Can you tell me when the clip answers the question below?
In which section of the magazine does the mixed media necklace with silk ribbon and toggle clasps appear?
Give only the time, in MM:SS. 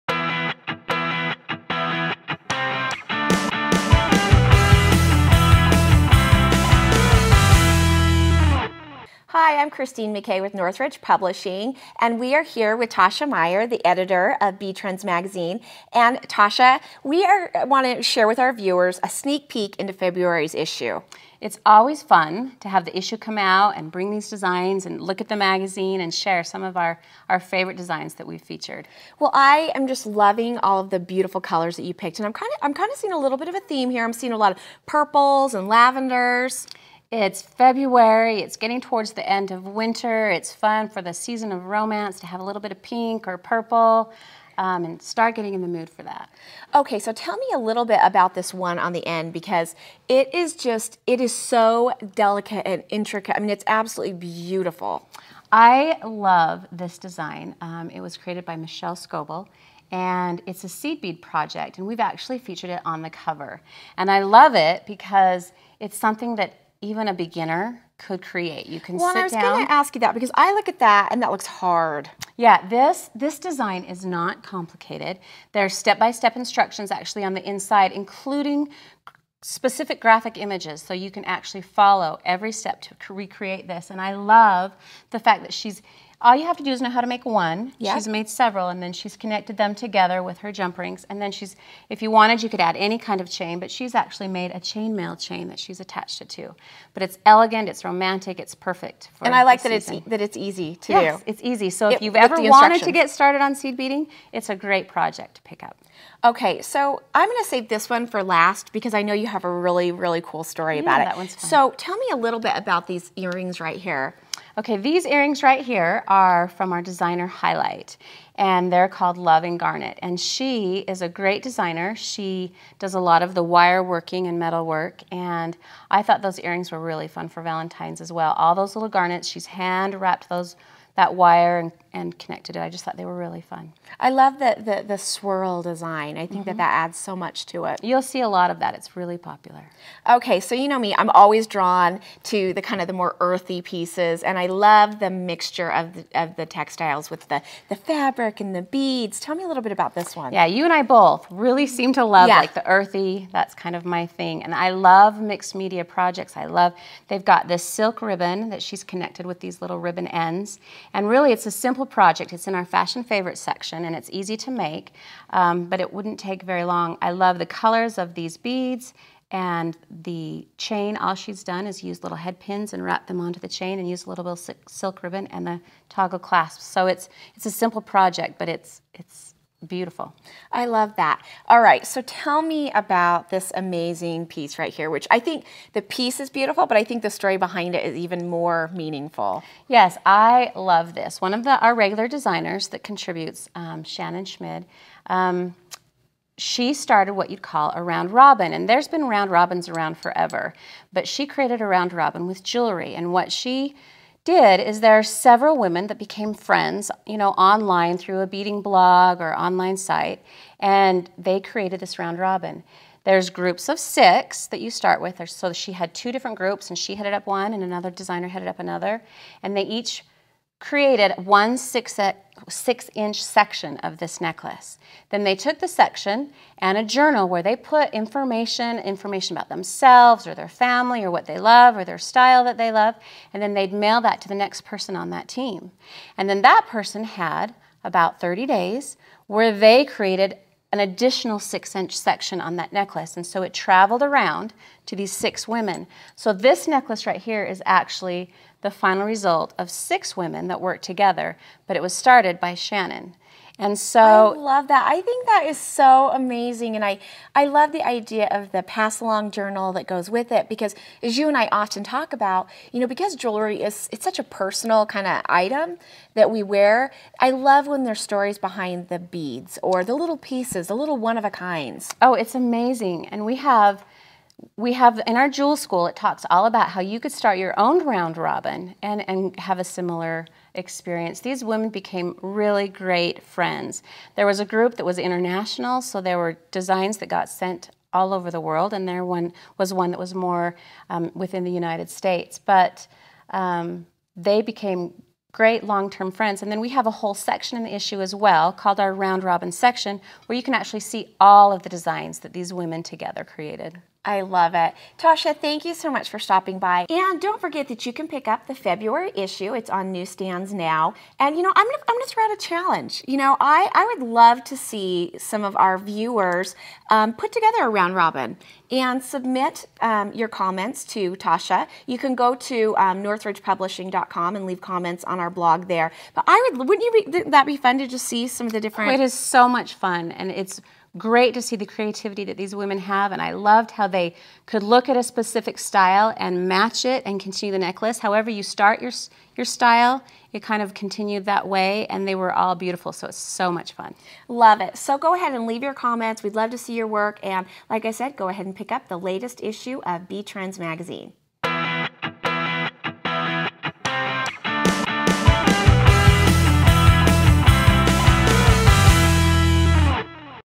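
02:42.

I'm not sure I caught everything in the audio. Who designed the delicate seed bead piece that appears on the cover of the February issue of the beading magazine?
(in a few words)
Michelle Scoble.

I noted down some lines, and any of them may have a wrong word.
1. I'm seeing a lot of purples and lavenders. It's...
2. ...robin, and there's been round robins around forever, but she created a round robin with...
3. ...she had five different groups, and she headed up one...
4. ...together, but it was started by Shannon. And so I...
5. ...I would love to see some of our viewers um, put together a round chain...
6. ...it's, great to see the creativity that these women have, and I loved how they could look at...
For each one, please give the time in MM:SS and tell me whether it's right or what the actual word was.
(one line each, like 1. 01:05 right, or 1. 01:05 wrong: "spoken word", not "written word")
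1. 00:34 right
2. 03:18 right
3. 03:35 wrong: "two", not "five"
4. 04:10 right
5. 05:13 wrong: "robin", not "chain"
6. 05:30 right.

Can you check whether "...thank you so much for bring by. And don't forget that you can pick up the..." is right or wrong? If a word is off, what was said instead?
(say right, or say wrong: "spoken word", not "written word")
wrong: "stopping", not "bring".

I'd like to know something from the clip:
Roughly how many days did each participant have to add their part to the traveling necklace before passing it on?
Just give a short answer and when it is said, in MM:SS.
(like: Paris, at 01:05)
30, at 03:58.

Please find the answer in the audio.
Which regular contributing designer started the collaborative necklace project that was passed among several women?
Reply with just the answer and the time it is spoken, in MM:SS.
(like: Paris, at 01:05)
Shannon Schmid, at 03:13.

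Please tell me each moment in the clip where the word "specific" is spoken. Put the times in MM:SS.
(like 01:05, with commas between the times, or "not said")
01:19, 05:35.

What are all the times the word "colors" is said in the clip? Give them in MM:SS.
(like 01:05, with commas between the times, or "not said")
00:31, 02:47.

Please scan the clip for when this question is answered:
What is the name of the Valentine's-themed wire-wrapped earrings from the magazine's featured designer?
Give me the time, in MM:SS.
01:59.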